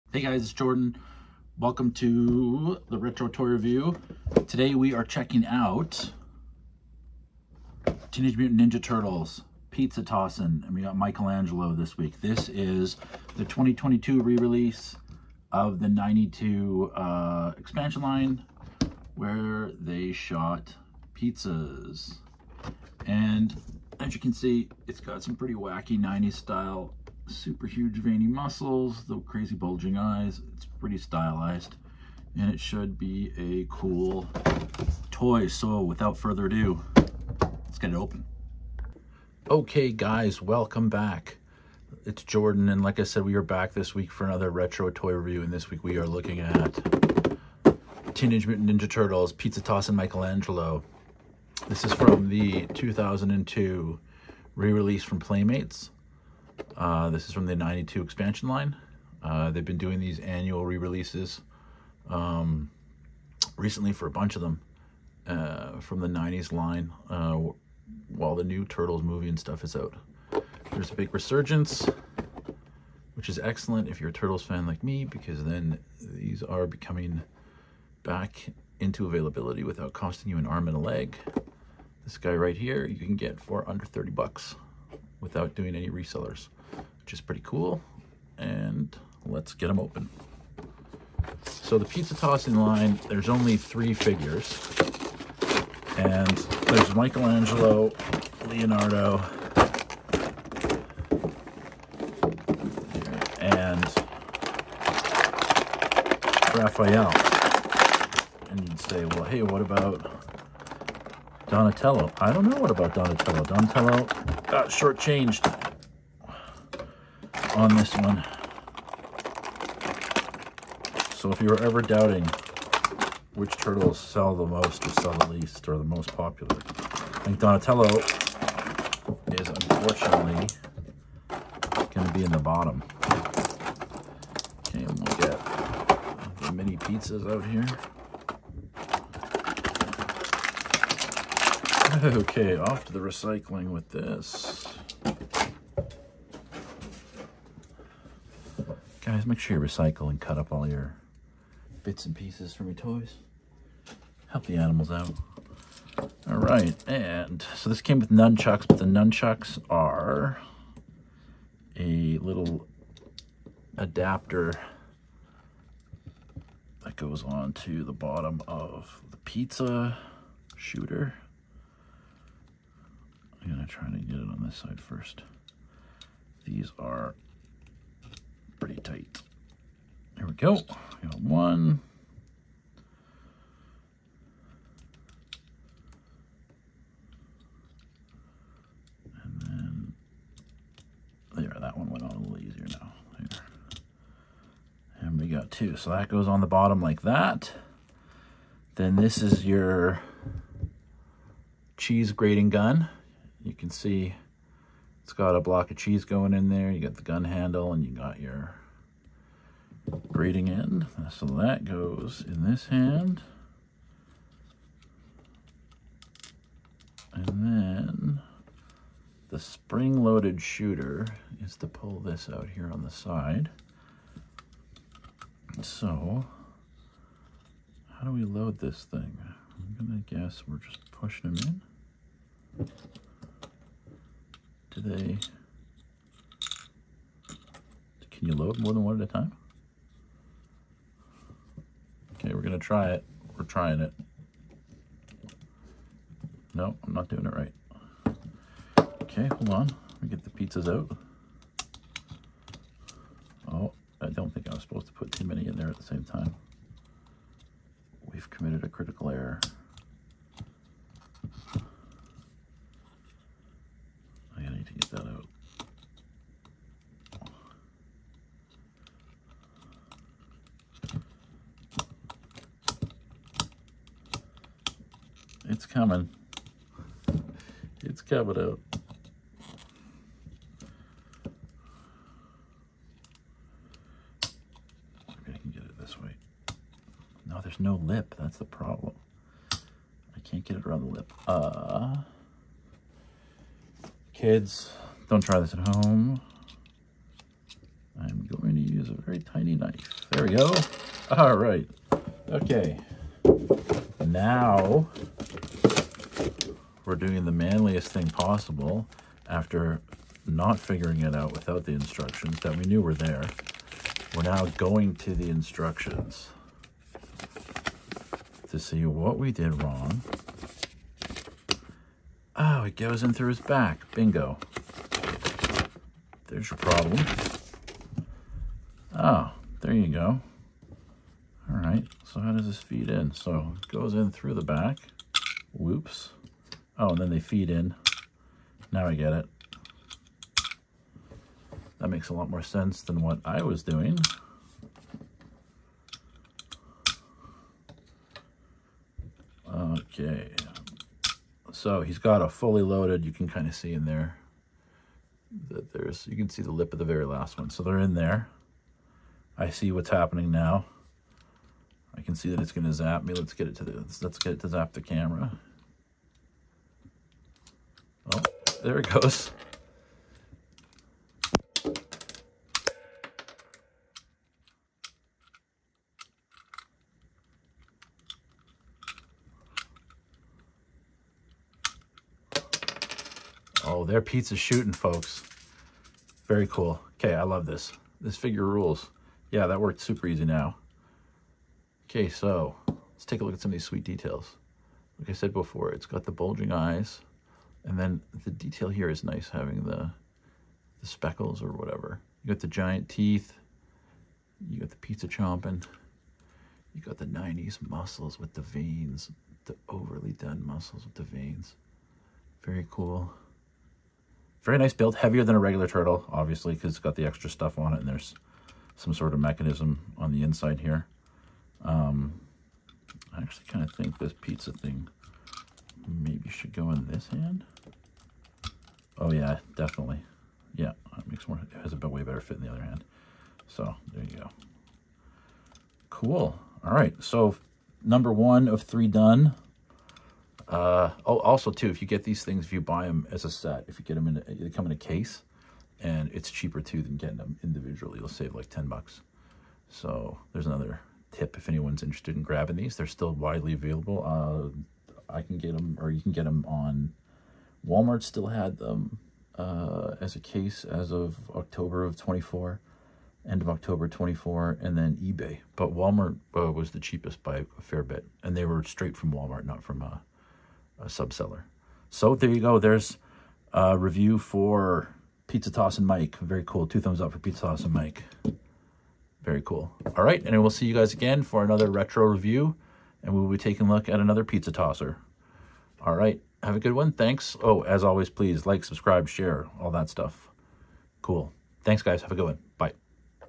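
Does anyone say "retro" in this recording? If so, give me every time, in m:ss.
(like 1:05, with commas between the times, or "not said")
0:02, 0:44, 8:01.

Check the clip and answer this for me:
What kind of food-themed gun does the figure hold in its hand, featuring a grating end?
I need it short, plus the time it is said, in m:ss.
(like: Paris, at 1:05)
Cheese grating gun, at 3:21.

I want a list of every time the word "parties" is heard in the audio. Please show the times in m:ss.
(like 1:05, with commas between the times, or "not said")
not said.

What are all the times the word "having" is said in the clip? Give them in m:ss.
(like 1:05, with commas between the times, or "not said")
6:39.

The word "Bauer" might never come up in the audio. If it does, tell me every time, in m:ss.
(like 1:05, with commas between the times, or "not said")
not said.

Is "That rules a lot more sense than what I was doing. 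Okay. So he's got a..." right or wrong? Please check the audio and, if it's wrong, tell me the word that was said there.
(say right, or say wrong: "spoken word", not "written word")
wrong: "makes", not "rules".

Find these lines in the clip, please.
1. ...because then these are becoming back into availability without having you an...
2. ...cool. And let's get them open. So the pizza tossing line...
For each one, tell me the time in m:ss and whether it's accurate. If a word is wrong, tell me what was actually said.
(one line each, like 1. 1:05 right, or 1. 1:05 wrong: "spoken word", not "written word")
1. 1:15 wrong: "costing", not "having"
2. 1:27 right.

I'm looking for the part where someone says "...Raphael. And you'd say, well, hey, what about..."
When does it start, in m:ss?
1:46.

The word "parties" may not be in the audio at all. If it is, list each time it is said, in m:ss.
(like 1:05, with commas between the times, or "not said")
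not said.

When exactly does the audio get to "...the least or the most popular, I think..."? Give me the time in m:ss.
2:05.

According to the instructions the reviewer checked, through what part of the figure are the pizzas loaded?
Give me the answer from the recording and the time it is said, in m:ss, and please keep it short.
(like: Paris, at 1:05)
His back, at 5:23.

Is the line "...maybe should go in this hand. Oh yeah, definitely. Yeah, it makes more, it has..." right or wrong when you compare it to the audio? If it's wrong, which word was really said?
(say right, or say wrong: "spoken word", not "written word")
right.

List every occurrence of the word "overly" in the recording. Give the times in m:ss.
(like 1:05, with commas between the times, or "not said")
6:49.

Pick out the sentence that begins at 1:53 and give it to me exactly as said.
Donatello got uh, shortchanged on this one.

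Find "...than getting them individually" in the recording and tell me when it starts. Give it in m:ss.
7:26.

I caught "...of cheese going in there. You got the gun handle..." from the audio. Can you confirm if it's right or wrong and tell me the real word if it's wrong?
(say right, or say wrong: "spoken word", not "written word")
right.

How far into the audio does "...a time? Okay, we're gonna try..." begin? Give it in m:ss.
3:59.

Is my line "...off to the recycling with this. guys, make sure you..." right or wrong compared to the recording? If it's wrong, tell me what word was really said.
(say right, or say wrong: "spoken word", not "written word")
right.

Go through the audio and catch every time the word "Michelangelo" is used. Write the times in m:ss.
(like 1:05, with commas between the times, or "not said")
0:10, 0:49, 1:36.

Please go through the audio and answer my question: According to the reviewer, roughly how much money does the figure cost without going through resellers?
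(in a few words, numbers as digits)
Under 30 bucks.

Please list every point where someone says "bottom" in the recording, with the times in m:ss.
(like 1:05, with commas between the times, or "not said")
2:12, 2:47, 3:16.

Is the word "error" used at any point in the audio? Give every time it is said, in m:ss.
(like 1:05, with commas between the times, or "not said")
4:19.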